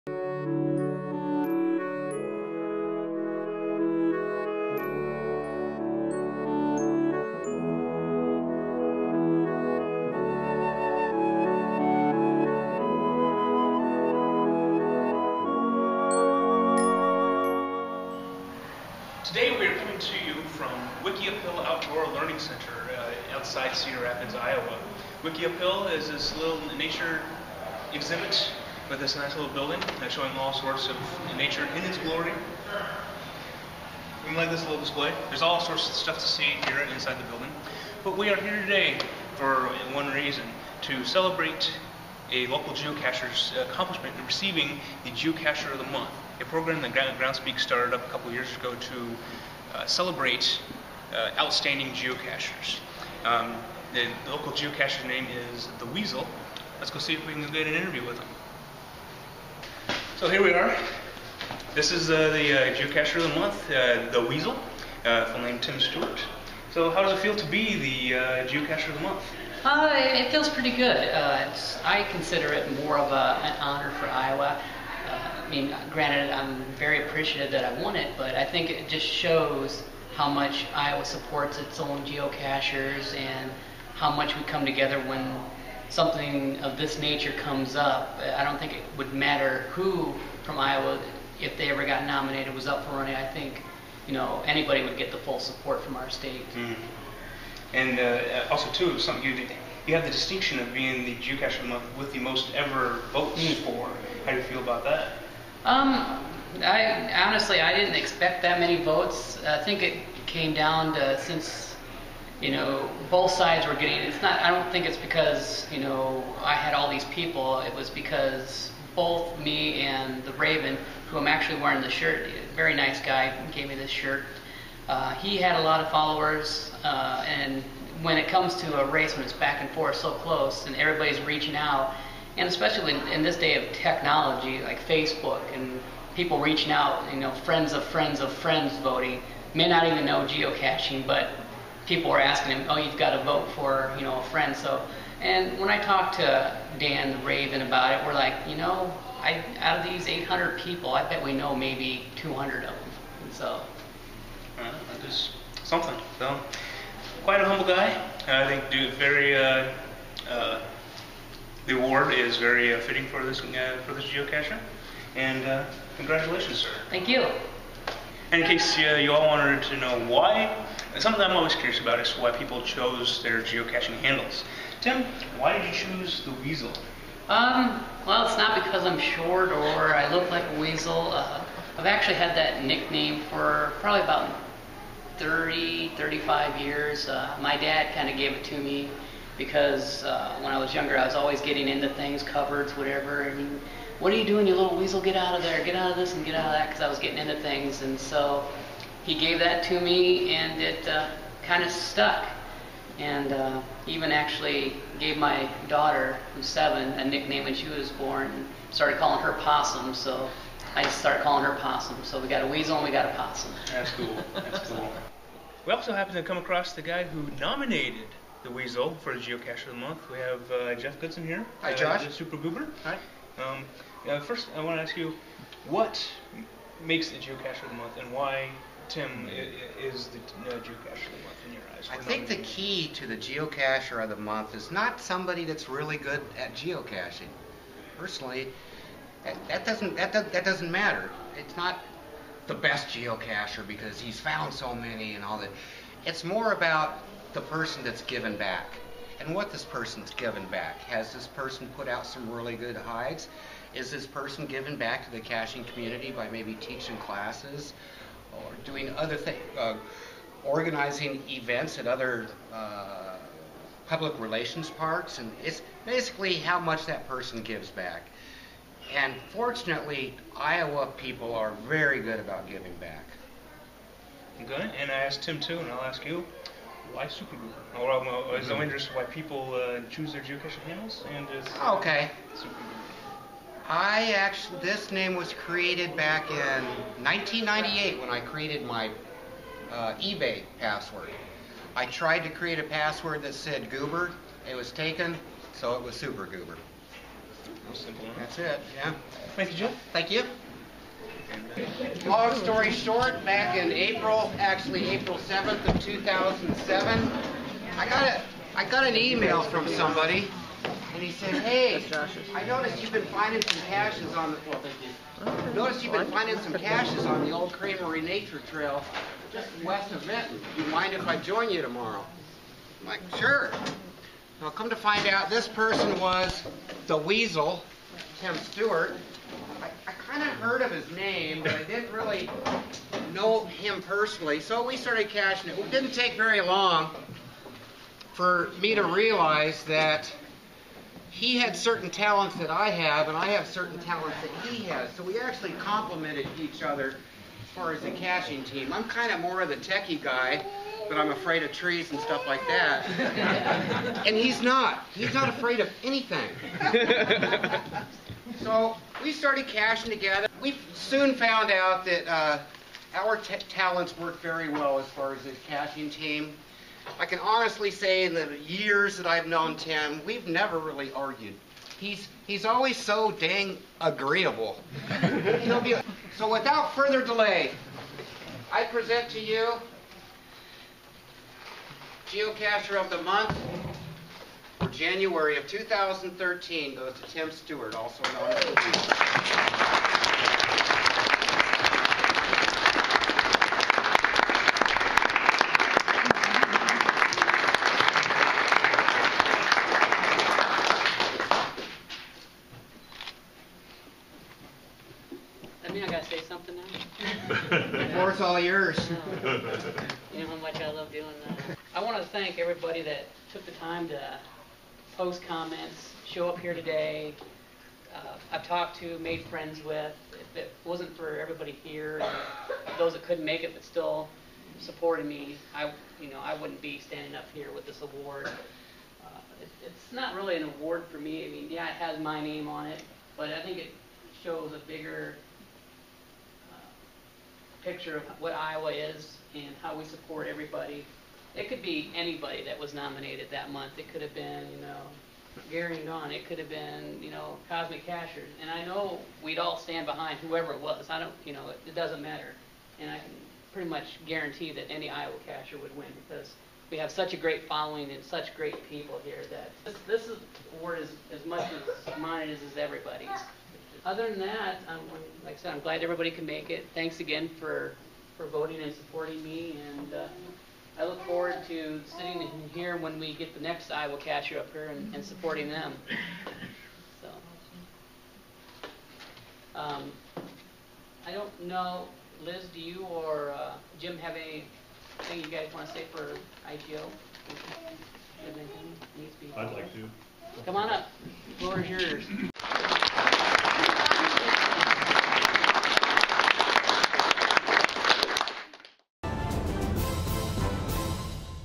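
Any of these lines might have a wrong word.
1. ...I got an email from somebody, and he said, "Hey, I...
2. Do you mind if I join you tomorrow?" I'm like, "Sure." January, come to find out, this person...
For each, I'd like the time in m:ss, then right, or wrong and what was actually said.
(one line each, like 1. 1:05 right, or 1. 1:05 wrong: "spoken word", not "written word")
1. 5:08 right
2. 5:20 wrong: "Now", not "January".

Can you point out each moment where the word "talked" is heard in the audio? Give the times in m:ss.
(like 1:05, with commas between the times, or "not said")
2:25, 6:58.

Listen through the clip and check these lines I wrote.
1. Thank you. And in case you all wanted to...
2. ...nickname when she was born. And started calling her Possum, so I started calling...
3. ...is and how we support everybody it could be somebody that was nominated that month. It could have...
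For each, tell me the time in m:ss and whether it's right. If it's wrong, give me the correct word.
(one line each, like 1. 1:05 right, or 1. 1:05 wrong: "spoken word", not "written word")
1. 2:46 right
2. 3:27 right
3. 7:18 wrong: "anybody", not "somebody".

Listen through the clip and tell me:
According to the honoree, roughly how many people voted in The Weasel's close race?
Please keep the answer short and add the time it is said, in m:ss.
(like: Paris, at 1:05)
800, at 2:30.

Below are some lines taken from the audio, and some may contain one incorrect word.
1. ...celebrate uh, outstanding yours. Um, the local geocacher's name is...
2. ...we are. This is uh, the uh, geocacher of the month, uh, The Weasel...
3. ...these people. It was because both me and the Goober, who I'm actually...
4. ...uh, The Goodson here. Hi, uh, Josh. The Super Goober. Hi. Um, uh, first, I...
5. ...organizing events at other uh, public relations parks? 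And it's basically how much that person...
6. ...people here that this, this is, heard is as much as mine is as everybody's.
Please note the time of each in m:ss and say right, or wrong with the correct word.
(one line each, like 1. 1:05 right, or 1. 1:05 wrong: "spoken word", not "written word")
1. 0:49 wrong: "geocachers", not "yours"
2. 1:00 right
3. 1:56 wrong: "Raven", not "Goober"
4. 3:40 wrong: "Jeff", not "The"
5. 4:20 right
6. 7:38 wrong: "award", not "heard".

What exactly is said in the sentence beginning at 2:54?
Tim, why did you choose the weasel?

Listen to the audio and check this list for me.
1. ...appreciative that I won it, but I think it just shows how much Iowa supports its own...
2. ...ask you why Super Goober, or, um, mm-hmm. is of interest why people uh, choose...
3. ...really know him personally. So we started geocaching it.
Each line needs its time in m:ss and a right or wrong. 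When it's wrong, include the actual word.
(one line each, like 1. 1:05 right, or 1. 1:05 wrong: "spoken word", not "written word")
1. 1:17 right
2. 4:35 right
3. 5:31 wrong: "caching", not "geocaching".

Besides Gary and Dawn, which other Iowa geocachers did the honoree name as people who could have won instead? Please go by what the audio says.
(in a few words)
Cosmic Cachers.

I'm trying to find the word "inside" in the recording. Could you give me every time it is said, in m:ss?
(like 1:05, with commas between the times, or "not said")
0:36.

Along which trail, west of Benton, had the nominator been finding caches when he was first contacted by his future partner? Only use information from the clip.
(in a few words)
Old Creamery Nature Trail.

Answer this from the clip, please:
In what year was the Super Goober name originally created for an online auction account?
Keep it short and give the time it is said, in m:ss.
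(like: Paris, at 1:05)
1998, at 4:47.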